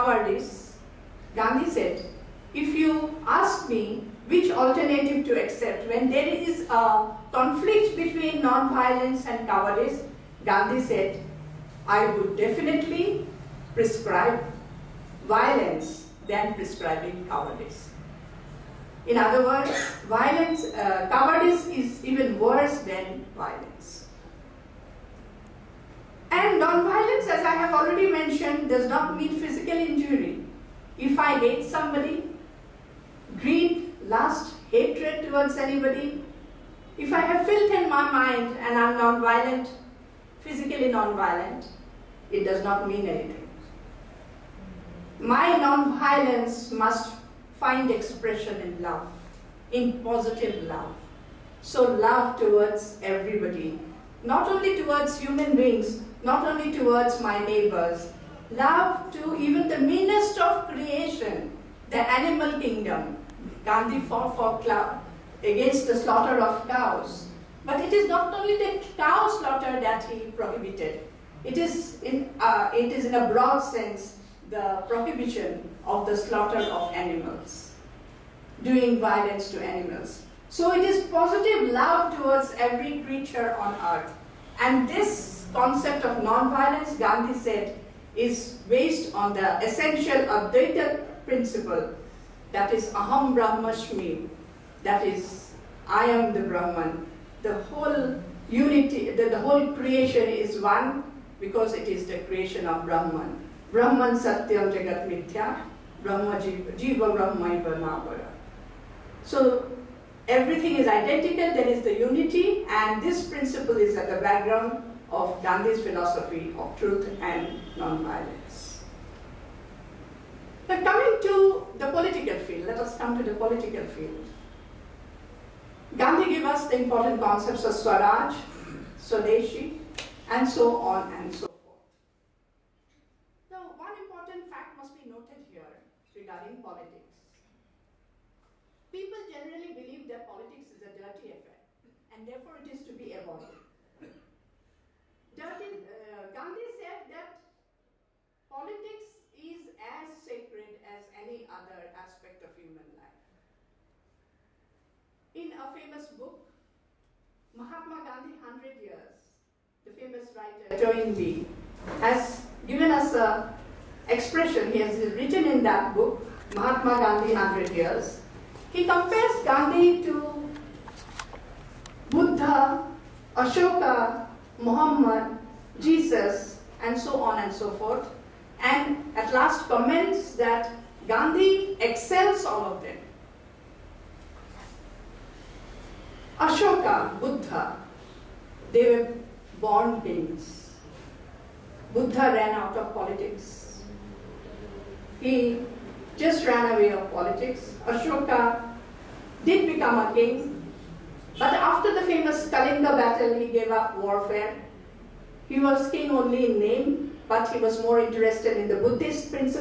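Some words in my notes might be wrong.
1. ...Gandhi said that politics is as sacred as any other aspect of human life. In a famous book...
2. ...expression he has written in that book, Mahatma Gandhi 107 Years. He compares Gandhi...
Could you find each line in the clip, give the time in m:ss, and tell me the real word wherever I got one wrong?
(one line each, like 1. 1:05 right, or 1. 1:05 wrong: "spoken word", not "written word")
1. 2:26 right
2. 2:44 wrong: "100", not "107".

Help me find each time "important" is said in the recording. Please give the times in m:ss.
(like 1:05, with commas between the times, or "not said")
2:06, 2:13.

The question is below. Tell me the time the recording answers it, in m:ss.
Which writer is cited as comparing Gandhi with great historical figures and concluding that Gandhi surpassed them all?
2:40.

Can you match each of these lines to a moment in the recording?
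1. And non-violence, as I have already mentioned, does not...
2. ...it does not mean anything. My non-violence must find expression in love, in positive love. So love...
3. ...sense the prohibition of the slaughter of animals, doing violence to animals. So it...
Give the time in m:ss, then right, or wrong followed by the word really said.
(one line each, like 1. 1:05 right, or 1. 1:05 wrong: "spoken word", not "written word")
1. 0:26 right
2. 0:42 right
3. 1:13 right.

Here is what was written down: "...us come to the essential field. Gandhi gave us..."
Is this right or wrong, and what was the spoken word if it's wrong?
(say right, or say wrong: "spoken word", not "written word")
wrong: "political", not "essential".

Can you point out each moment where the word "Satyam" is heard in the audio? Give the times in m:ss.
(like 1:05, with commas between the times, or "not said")
1:44.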